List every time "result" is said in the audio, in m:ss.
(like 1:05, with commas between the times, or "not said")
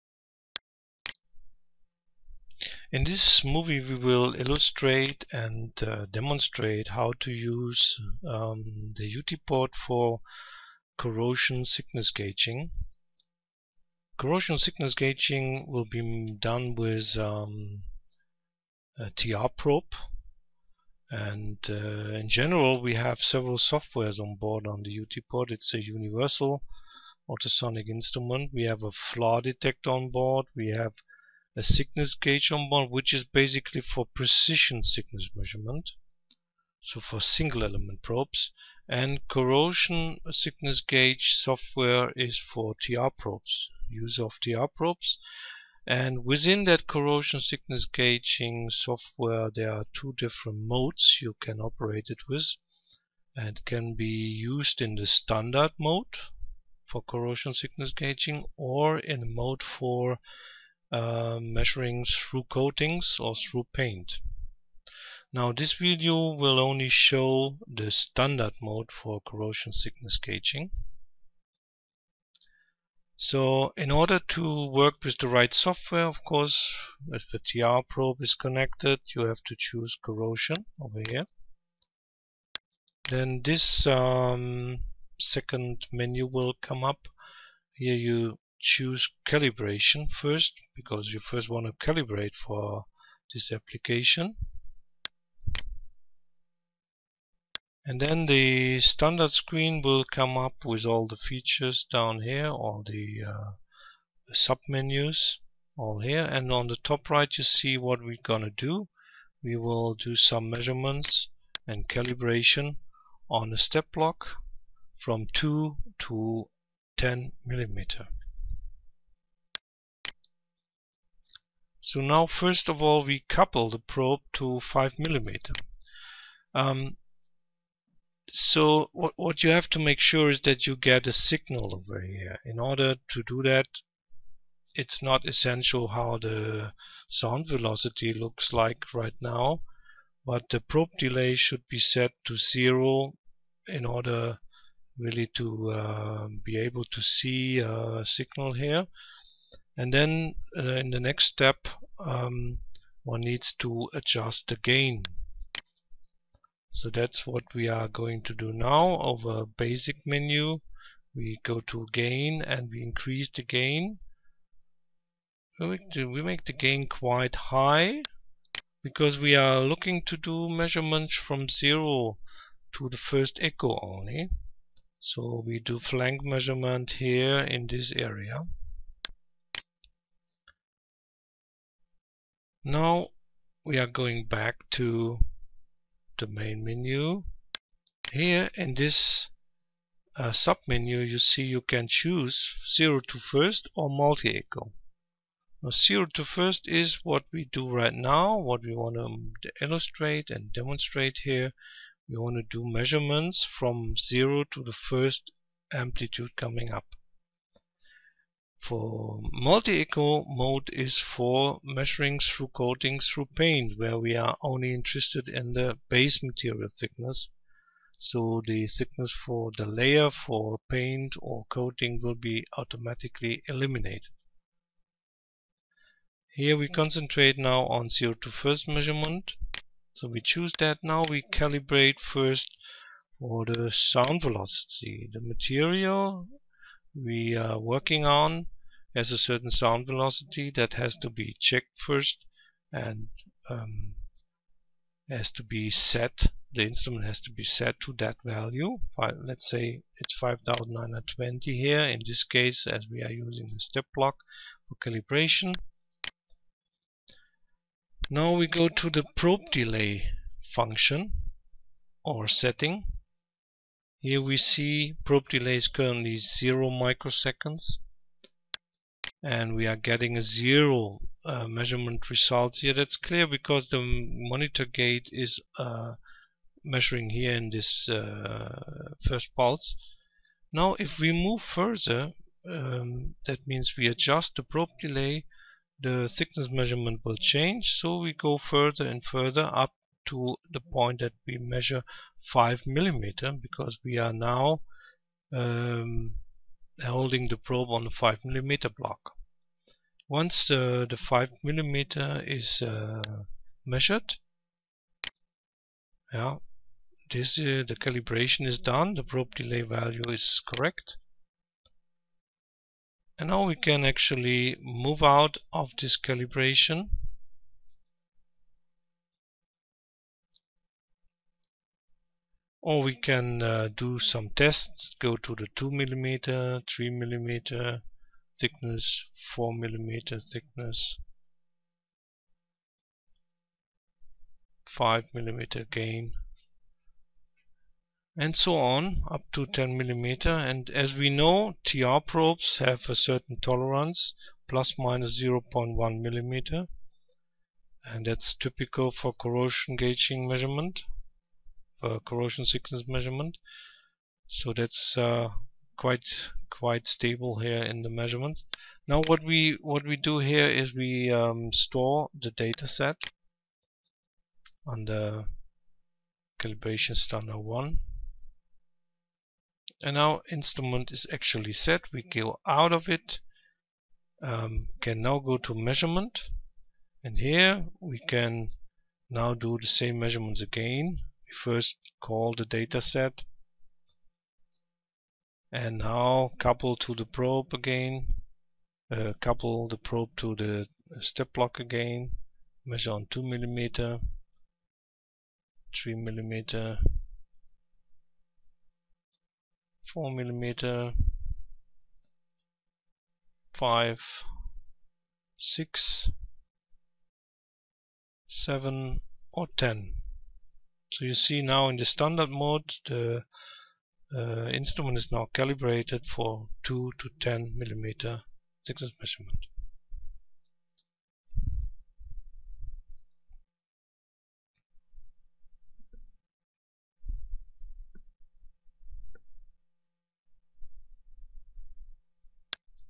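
4:32.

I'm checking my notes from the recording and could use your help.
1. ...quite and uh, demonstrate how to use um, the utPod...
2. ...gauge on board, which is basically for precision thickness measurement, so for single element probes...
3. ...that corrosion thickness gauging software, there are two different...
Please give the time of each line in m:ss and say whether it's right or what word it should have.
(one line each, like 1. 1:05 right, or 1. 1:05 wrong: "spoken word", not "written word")
1. 0:04 wrong: "illustrate", not "quite"
2. 0:32 right
3. 0:46 right.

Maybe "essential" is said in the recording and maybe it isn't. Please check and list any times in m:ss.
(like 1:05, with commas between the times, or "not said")
2:15.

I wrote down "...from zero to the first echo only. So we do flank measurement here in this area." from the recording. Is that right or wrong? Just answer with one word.
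right.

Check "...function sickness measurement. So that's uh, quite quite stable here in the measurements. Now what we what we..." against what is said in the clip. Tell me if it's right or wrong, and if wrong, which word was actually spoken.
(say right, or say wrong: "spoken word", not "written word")
wrong: "corrosion", not "function".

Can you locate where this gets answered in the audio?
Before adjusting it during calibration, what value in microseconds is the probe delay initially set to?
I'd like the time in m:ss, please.
4:26.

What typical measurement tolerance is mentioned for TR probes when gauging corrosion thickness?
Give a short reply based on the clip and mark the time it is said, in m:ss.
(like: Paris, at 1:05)
plus minus 0.1 millimeter, at 5:44.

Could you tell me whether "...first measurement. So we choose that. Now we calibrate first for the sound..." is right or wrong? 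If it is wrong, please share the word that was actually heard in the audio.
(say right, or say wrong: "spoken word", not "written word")
right.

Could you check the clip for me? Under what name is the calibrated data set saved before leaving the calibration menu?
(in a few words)
calibration standard 1.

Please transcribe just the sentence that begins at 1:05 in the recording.
Now this video will only show the standard mode for corrosion thickness gauging.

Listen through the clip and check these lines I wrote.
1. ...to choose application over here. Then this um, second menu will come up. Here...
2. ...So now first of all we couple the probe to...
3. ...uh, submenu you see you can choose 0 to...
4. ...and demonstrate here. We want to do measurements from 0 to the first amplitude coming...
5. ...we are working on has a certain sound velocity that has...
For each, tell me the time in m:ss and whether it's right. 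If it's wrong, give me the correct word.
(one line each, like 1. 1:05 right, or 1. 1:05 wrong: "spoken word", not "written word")
1. 1:19 wrong: "corrosion", not "application"
2. 2:01 right
3. 3:10 right
4. 3:20 right
5. 3:56 right.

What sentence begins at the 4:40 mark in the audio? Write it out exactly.
Now if we move further, um, that means we adjust the probe delay, the thickness measurement will change.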